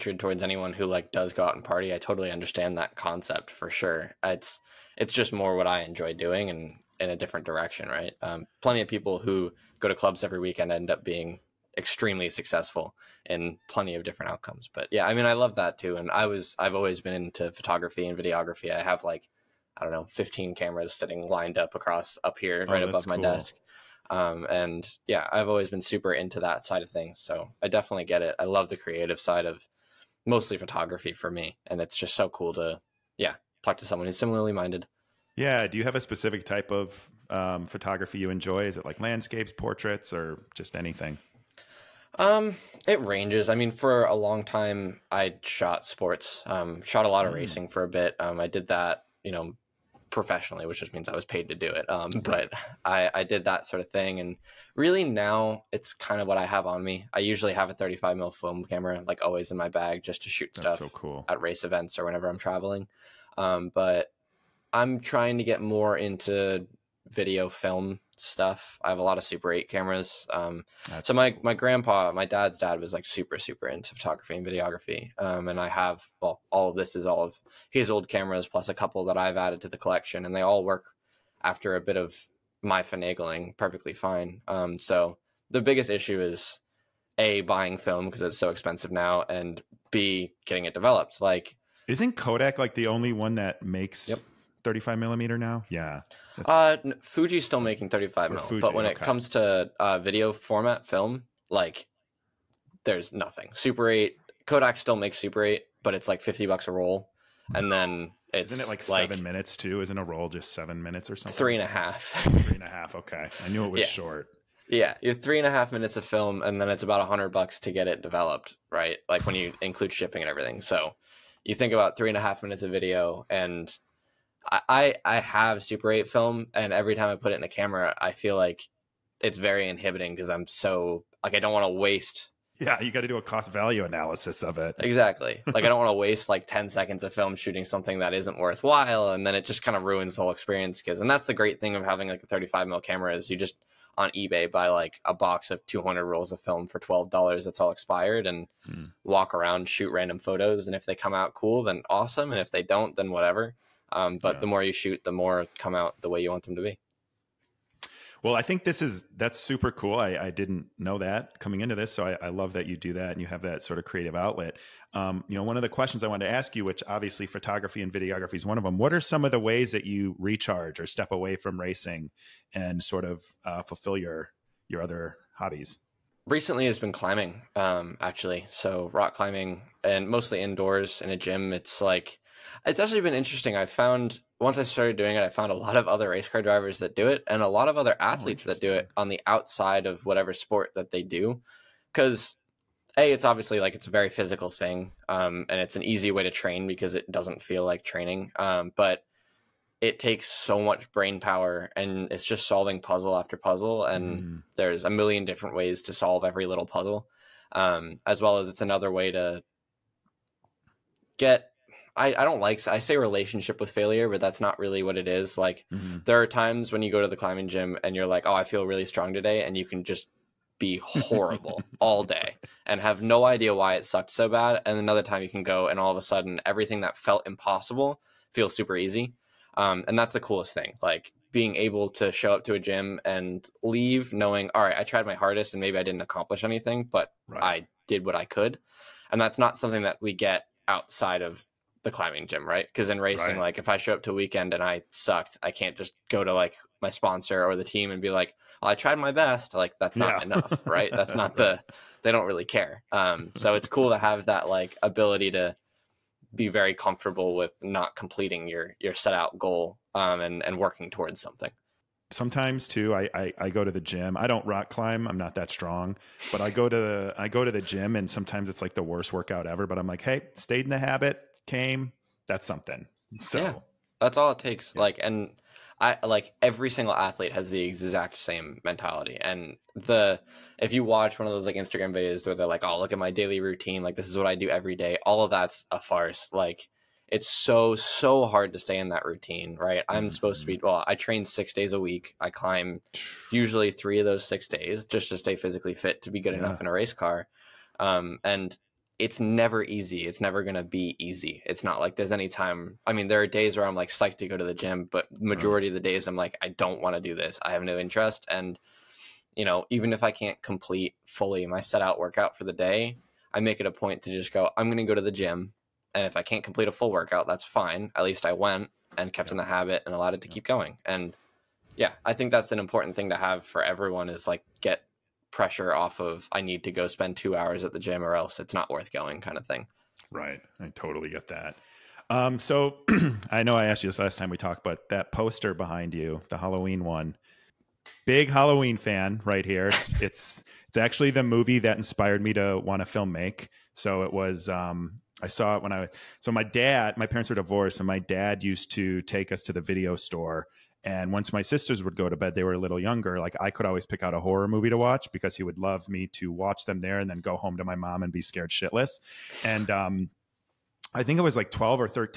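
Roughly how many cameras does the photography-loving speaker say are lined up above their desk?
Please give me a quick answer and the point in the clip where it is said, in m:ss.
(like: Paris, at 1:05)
15, at 0:20.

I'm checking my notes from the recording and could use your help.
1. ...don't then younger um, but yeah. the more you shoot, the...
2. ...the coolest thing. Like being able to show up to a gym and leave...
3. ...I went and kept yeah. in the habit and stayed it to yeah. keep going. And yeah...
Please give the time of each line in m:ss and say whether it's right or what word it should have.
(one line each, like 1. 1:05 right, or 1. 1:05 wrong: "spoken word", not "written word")
1. 2:32 wrong: "whatever", not "younger"
2. 3:50 right
3. 5:18 wrong: "allowed", not "stayed".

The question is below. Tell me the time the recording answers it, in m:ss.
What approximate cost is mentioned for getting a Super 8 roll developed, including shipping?
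1:56.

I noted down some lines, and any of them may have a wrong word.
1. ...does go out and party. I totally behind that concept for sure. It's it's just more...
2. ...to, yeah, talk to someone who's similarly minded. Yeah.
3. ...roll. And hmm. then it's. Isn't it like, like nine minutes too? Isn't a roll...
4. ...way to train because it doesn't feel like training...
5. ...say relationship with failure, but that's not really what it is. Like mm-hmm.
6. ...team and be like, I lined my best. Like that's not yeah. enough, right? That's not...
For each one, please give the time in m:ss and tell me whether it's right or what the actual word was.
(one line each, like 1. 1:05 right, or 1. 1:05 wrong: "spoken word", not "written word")
1. 0:01 wrong: "understand", not "behind"
2. 0:32 right
3. 1:46 wrong: "seven", not "nine"
4. 3:16 right
5. 3:32 right
6. 4:07 wrong: "tried", not "lined".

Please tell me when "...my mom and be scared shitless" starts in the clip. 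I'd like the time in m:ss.
5:57.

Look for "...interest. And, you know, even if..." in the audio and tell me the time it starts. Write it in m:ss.
5:07.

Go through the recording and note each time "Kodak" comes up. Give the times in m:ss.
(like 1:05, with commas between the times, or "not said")
1:32, 1:44.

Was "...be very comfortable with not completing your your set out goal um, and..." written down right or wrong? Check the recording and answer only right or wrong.
right.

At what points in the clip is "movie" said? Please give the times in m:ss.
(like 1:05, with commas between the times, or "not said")
5:41, 5:54.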